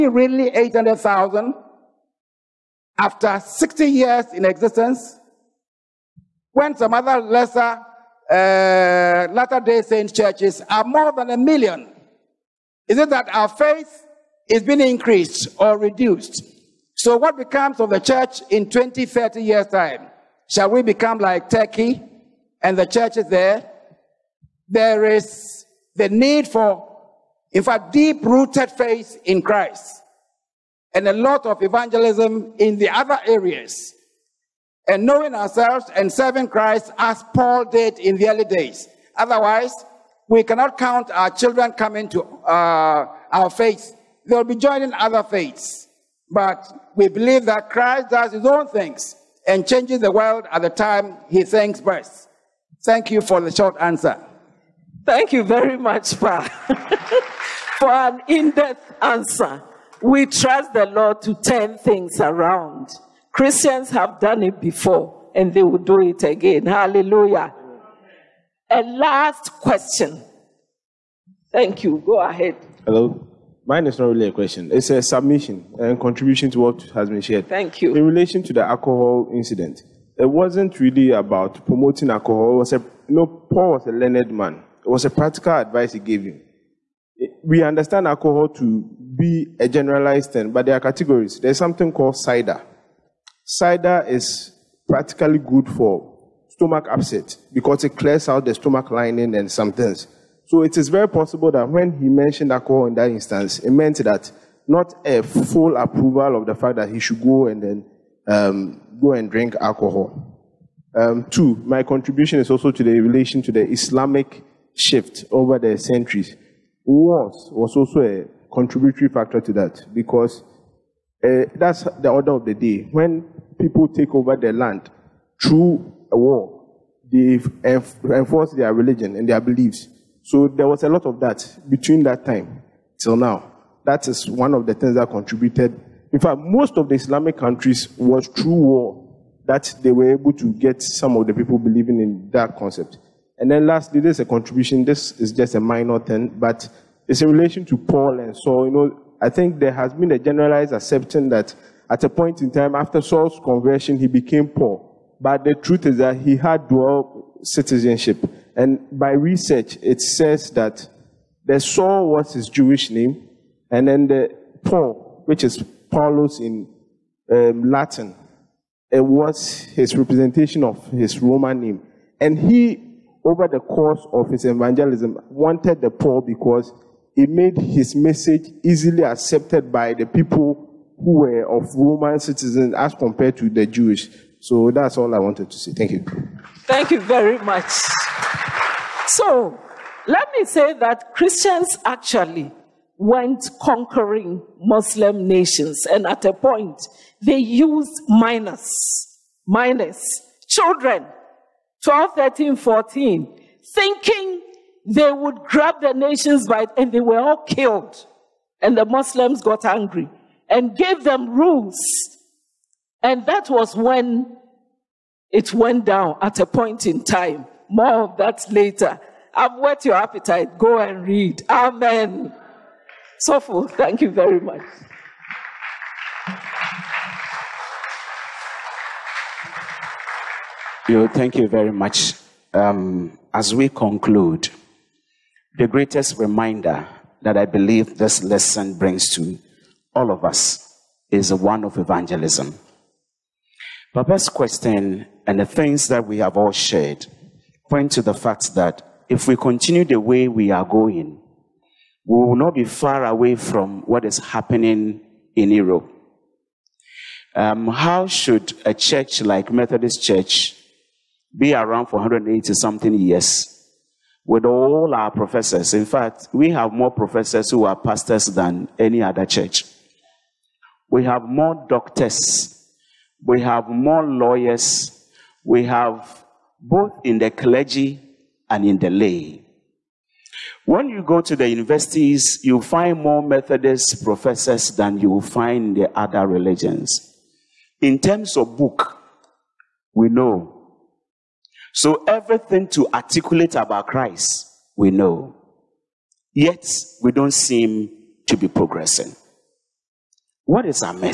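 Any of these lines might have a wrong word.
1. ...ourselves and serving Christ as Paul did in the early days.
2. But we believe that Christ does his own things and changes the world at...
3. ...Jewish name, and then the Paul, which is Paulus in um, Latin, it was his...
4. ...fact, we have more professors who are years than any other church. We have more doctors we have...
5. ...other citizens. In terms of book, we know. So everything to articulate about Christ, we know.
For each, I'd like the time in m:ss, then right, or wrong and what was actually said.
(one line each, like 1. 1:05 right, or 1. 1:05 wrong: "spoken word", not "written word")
1. 0:35 right
2. 0:46 right
3. 2:42 right
4. 4:25 wrong: "pastors", not "years"
5. 4:45 wrong: "religions", not "citizens".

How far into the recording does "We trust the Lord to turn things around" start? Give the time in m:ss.
1:00.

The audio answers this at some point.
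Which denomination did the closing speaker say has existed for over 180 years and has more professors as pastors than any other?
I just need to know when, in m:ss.
4:19.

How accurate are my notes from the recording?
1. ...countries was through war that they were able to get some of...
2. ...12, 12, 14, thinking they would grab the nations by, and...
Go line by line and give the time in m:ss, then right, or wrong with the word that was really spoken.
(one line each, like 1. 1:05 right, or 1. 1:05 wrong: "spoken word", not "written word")
1. 2:17 right
2. 3:21 wrong: "13", not "12".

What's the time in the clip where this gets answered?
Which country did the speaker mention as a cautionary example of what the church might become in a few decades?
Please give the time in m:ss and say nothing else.
0:21.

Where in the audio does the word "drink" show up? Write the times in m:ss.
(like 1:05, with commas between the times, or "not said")
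1:49.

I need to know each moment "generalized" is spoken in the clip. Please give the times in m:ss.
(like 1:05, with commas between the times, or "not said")
1:29, 2:30.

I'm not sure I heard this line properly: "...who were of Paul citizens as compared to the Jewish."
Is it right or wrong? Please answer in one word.
wrong.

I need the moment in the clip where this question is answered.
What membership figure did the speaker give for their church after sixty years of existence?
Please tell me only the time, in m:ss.
0:00.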